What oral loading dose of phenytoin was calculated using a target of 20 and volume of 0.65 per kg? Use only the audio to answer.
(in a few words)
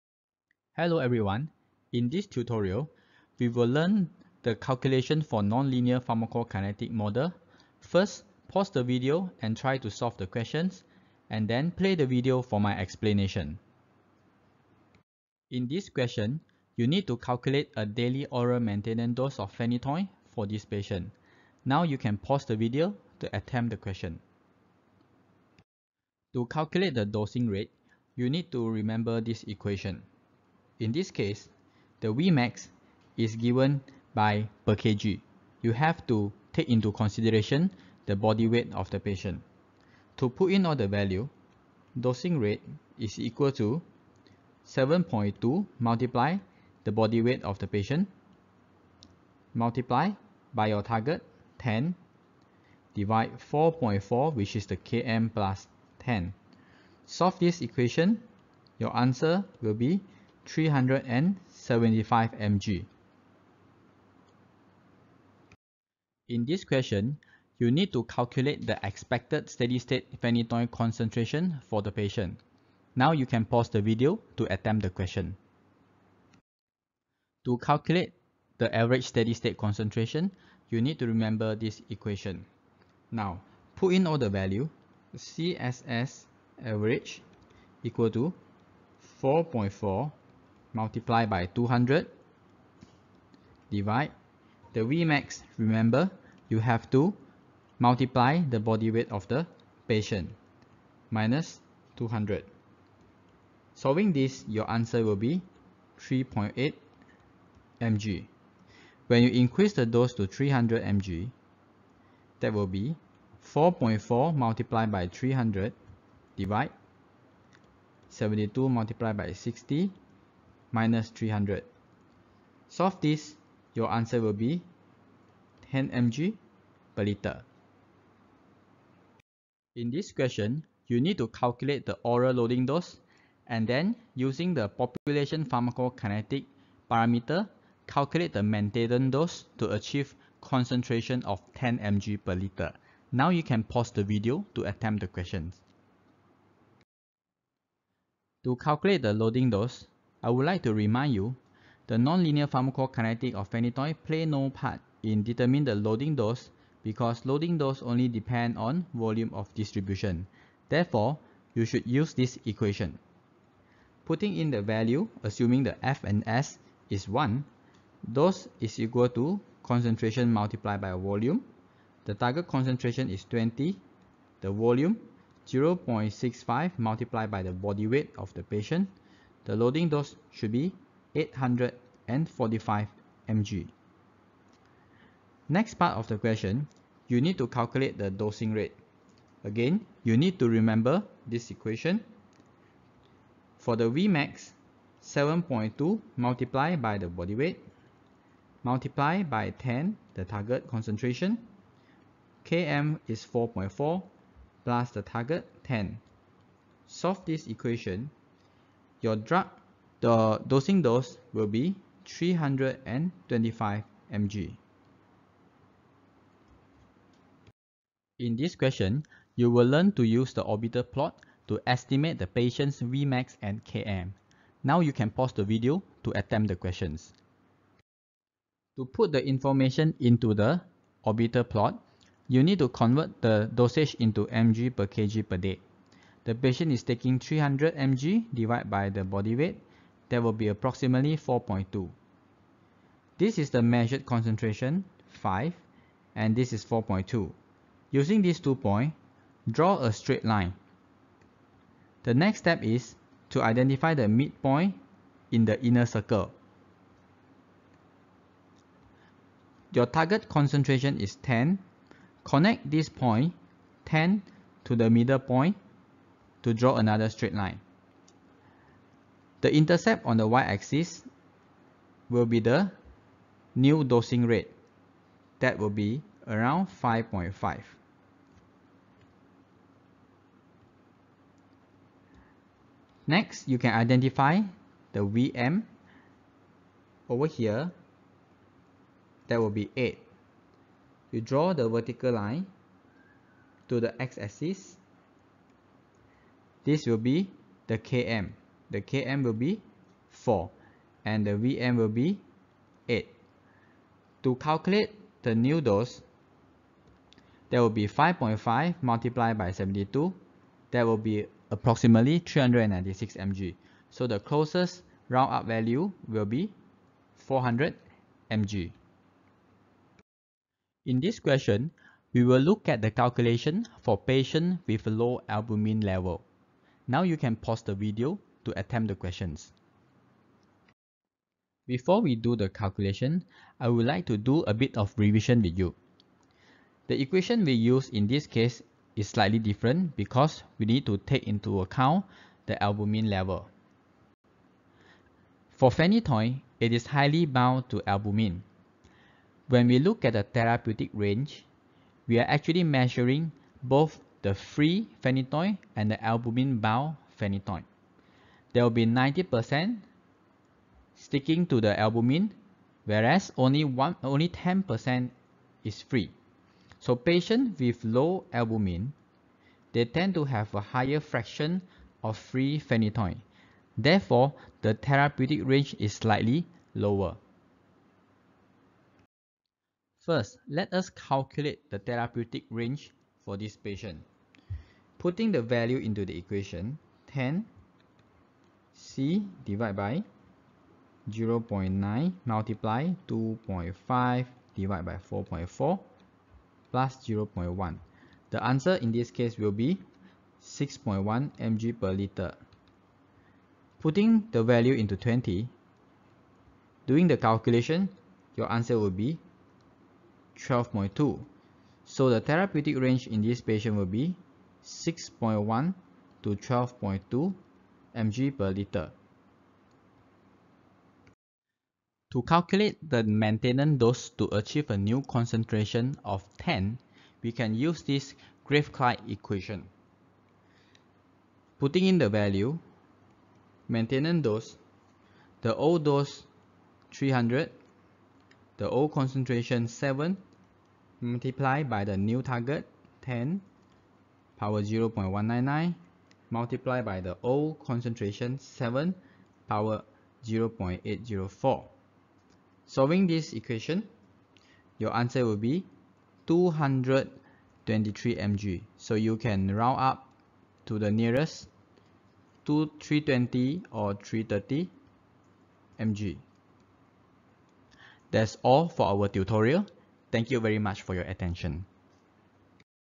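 845 mg.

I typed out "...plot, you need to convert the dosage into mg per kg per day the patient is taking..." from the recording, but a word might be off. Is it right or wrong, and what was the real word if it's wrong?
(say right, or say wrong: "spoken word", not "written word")
right.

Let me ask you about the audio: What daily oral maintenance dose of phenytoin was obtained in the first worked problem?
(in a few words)
375 mg.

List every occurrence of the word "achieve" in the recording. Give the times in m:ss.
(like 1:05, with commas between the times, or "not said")
2:19, 7:04.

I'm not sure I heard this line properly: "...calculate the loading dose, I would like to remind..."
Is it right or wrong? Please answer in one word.
right.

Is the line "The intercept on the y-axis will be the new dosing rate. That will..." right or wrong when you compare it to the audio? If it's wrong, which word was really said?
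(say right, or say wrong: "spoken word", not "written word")
right.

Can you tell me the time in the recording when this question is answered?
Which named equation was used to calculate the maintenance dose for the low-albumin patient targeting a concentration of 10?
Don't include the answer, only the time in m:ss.
7:08.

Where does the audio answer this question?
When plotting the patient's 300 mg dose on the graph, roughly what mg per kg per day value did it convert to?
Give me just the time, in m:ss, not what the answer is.
4:00.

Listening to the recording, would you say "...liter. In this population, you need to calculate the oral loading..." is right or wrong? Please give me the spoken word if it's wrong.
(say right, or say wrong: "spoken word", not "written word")
wrong: "question", not "population".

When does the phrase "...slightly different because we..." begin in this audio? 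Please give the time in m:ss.
5:39.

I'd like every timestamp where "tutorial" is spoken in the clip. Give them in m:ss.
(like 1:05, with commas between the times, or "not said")
0:02, 7:49.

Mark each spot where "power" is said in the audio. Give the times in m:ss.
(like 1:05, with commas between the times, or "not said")
7:24, 7:29.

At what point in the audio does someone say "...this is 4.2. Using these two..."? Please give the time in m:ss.
4:06.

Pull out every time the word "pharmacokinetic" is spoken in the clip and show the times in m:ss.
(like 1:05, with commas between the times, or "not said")
0:05, 2:15, 2:32.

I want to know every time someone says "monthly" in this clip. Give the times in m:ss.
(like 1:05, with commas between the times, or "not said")
not said.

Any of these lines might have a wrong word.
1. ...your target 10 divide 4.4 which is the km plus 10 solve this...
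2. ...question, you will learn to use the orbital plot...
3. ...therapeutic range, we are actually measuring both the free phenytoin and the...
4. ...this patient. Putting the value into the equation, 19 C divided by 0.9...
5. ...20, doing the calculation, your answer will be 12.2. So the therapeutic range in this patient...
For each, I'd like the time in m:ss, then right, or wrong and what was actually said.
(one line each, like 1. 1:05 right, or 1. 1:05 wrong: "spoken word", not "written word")
1. 0:50 right
2. 3:38 right
3. 5:50 right
4. 6:23 wrong: "10", not "19"
5. 6:44 right.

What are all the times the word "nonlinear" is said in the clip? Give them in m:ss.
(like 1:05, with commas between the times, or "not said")
0:05, 2:31.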